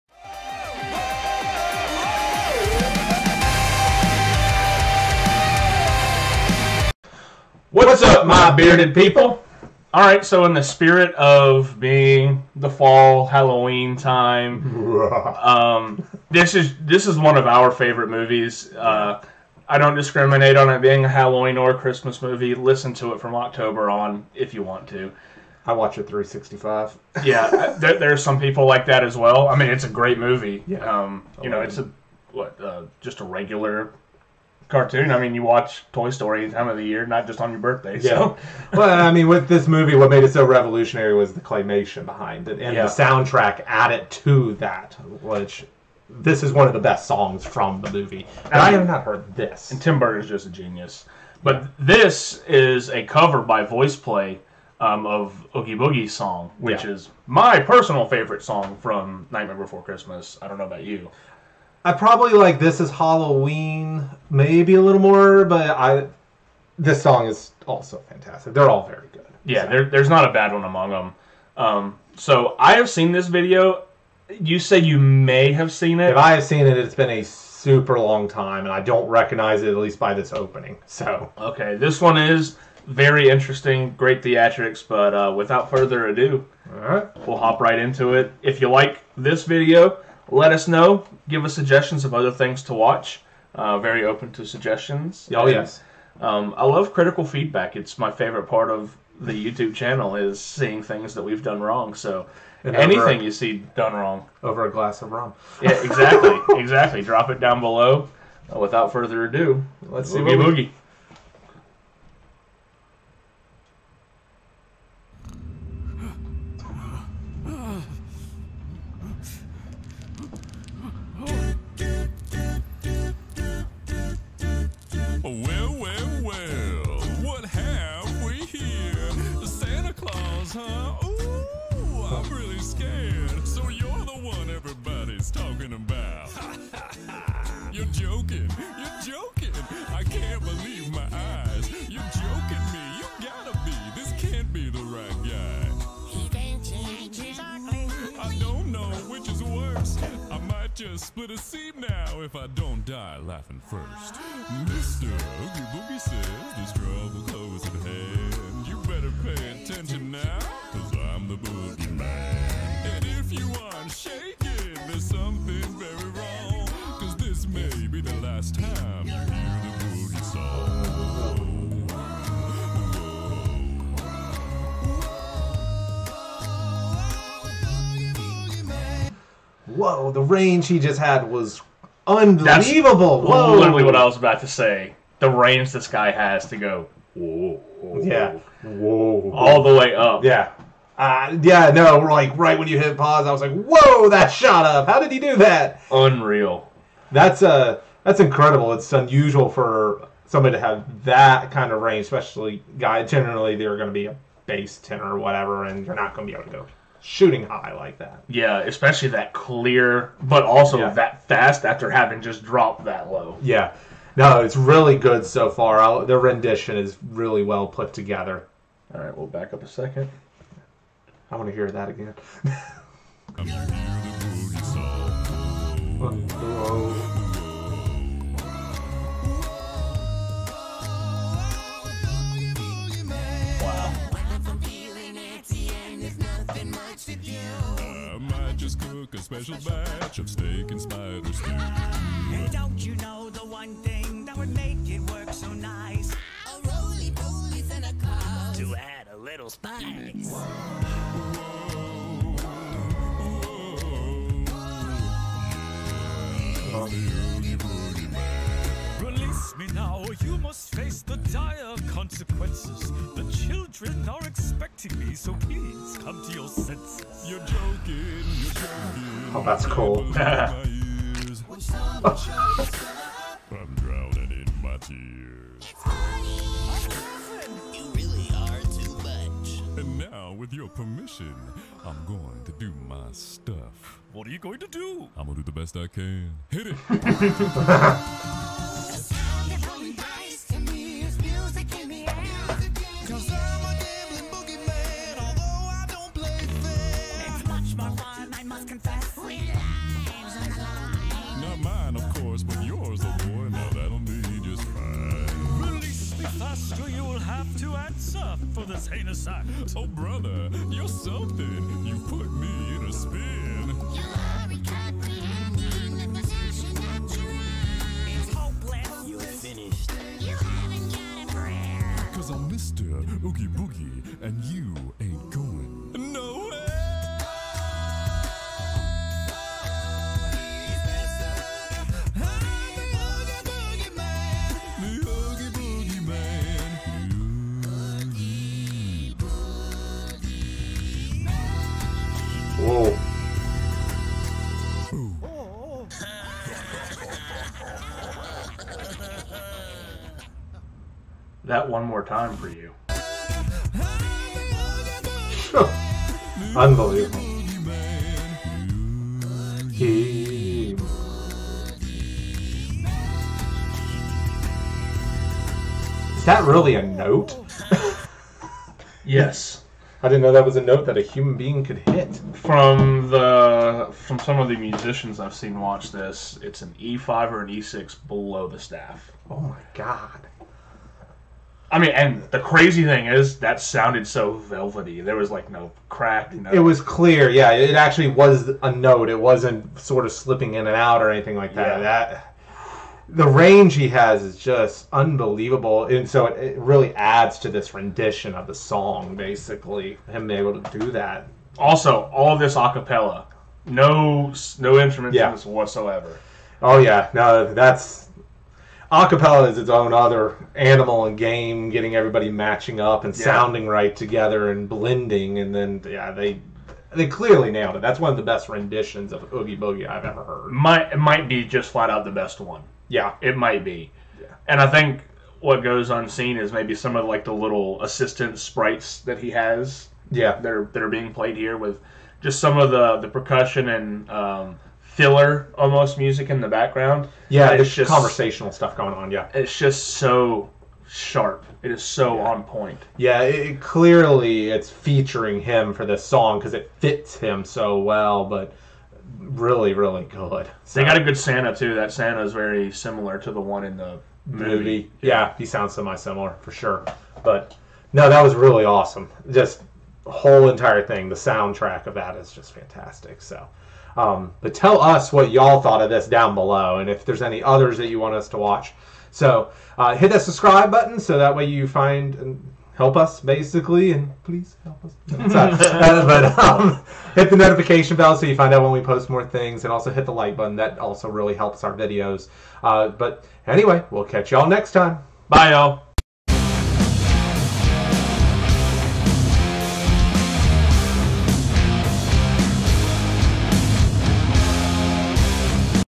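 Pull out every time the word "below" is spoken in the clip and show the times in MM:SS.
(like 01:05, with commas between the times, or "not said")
01:47, 06:18, 07:46.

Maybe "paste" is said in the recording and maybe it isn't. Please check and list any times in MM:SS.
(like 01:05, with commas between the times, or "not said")
not said.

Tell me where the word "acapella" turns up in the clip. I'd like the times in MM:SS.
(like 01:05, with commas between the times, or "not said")
06:42, 06:48.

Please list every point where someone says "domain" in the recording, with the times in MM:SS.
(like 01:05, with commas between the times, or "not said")
not said.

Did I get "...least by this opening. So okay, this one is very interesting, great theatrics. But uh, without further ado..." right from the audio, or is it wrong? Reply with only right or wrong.
right.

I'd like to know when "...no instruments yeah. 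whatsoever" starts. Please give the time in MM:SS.
06:44.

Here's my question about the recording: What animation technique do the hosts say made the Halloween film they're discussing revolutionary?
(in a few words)
Claymation.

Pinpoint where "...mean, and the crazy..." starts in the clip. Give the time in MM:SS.
06:21.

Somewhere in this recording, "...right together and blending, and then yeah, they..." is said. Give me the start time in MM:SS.
06:53.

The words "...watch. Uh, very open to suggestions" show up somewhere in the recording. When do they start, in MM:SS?
01:32.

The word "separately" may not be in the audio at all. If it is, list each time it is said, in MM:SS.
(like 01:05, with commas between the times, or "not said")
not said.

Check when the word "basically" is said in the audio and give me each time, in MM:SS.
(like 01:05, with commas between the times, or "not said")
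06:39, 07:53.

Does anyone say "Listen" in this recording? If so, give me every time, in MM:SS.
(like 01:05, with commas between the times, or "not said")
00:22.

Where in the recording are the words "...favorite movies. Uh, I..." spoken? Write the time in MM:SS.
00:17.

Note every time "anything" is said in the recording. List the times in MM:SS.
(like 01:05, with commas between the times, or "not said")
01:42, 06:31.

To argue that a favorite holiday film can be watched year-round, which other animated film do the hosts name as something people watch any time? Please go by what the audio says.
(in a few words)
Toy Story.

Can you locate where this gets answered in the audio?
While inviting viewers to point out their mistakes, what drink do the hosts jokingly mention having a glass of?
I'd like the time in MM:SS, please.
01:45.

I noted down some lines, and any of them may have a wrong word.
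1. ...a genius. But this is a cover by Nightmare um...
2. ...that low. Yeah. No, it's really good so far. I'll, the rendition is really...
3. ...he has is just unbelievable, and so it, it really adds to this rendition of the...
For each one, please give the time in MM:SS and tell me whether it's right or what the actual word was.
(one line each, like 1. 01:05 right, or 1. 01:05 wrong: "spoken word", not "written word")
1. 00:50 wrong: "VoicePlay", not "Nightmare"
2. 03:32 right
3. 06:33 right.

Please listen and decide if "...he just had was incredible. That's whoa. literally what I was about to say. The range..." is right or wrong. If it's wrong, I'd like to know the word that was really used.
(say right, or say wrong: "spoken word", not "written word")
wrong: "unbelievable", not "incredible".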